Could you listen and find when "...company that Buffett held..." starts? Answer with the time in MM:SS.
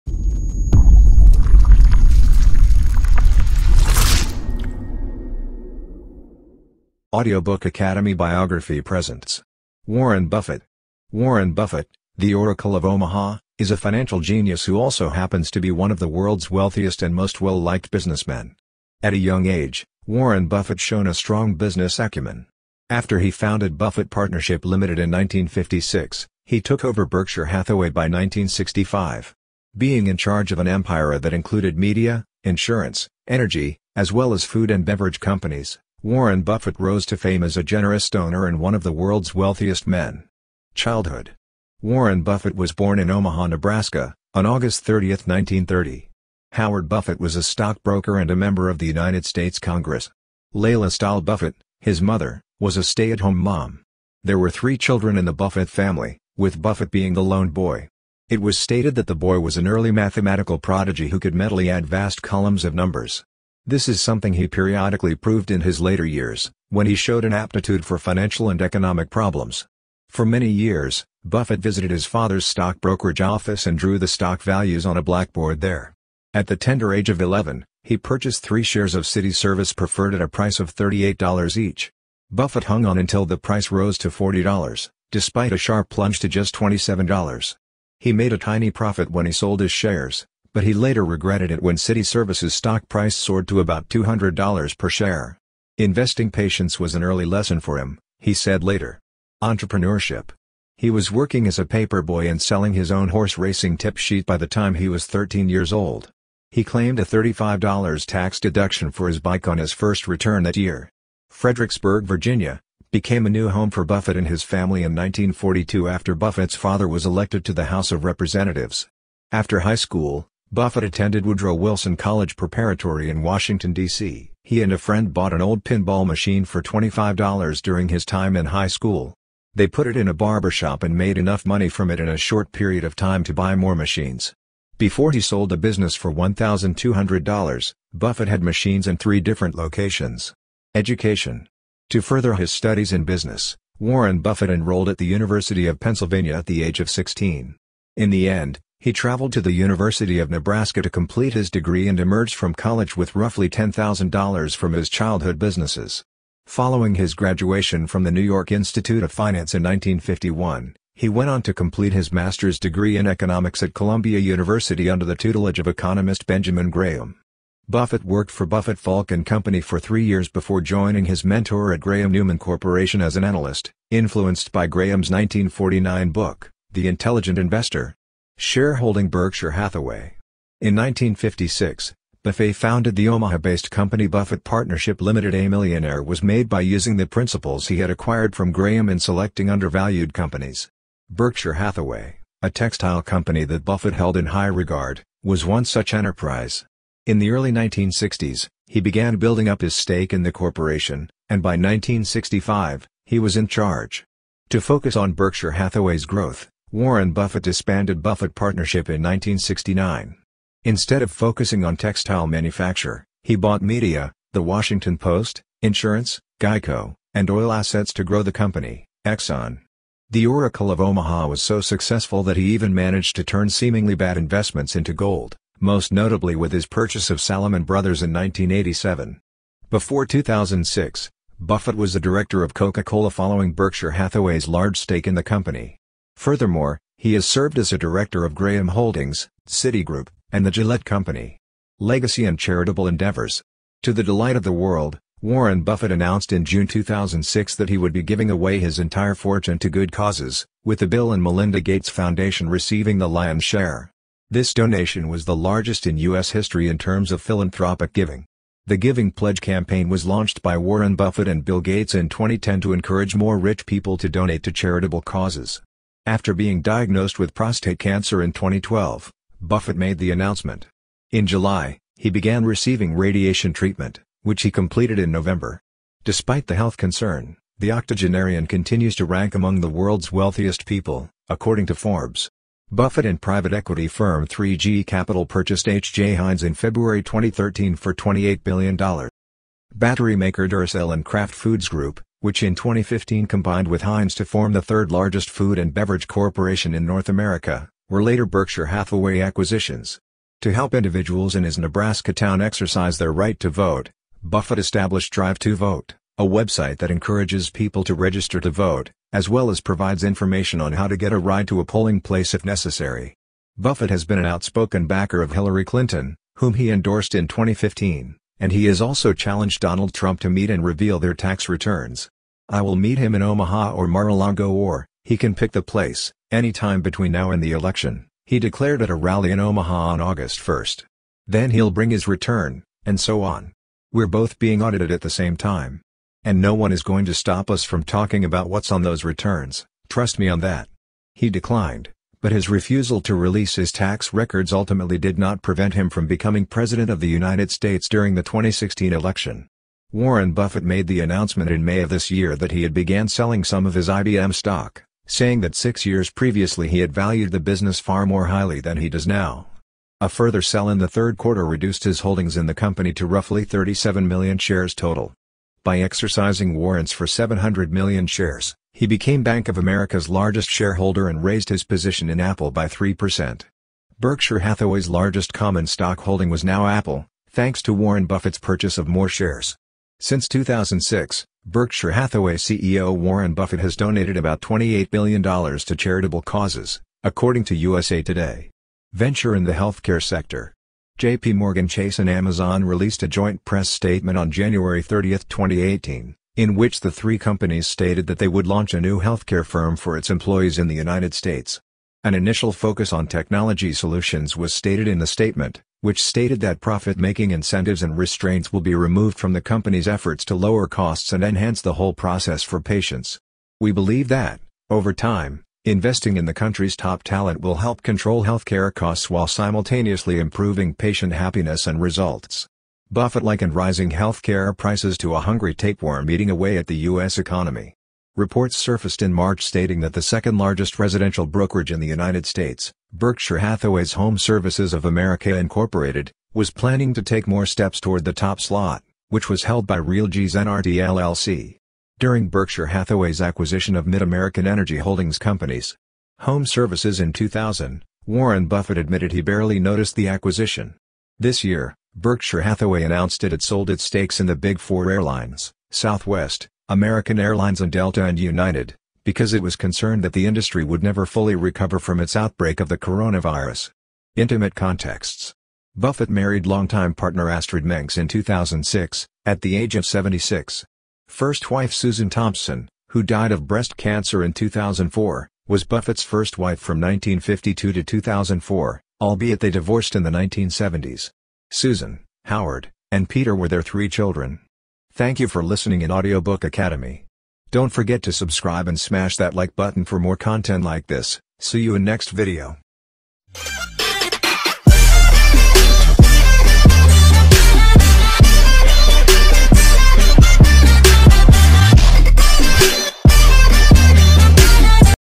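03:13.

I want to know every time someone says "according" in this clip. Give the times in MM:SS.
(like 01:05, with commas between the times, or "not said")
04:41, 06:27.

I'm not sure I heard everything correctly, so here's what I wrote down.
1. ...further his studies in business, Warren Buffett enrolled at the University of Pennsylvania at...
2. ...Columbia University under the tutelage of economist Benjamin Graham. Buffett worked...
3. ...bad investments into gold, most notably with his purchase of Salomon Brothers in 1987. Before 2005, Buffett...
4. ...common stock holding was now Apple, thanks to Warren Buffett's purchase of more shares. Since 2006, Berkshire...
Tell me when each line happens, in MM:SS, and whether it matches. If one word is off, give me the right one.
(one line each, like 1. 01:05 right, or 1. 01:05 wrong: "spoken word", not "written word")
1. 02:22 right
2. 02:43 right
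3. 03:43 wrong: "2006", not "2005"
4. 06:15 right.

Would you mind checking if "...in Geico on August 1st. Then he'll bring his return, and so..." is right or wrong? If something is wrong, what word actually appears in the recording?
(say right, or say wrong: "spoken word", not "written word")
wrong: "Omaha", not "Geico".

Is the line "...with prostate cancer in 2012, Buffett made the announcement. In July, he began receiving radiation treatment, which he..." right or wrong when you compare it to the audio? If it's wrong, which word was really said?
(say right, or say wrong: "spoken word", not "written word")
right.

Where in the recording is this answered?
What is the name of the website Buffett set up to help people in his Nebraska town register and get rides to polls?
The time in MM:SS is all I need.
05:05.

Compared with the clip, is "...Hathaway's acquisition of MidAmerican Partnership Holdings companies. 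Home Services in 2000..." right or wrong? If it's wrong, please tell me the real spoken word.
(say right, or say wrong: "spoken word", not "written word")
wrong: "Energy", not "Partnership".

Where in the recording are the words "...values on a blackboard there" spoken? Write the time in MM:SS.
01:14.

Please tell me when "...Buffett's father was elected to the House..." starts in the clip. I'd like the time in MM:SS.
01:56.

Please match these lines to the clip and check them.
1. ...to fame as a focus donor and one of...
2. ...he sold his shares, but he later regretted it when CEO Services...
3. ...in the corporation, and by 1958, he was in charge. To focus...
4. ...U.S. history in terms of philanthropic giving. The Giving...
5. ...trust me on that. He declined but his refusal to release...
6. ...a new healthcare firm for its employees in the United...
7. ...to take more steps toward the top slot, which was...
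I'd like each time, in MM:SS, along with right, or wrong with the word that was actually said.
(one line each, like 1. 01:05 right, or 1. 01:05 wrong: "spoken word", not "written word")
1. 00:37 wrong: "generous", not "focus"
2. 01:29 wrong: "City", not "CEO"
3. 03:20 wrong: "1965", not "1958"
4. 04:15 right
5. 05:39 right
6. 06:38 right
7. 07:16 right.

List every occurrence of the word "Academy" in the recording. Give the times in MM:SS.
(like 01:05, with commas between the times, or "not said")
00:07, 08:06.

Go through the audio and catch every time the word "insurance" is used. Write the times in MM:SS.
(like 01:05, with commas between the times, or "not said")
00:32, 03:35.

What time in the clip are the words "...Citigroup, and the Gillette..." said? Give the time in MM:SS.
03:59.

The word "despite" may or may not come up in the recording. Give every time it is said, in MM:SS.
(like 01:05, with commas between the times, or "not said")
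01:25, 04:36.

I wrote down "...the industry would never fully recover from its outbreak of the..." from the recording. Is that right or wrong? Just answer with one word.
right.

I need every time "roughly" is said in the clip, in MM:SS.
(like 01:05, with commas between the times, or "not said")
02:33, 06:03.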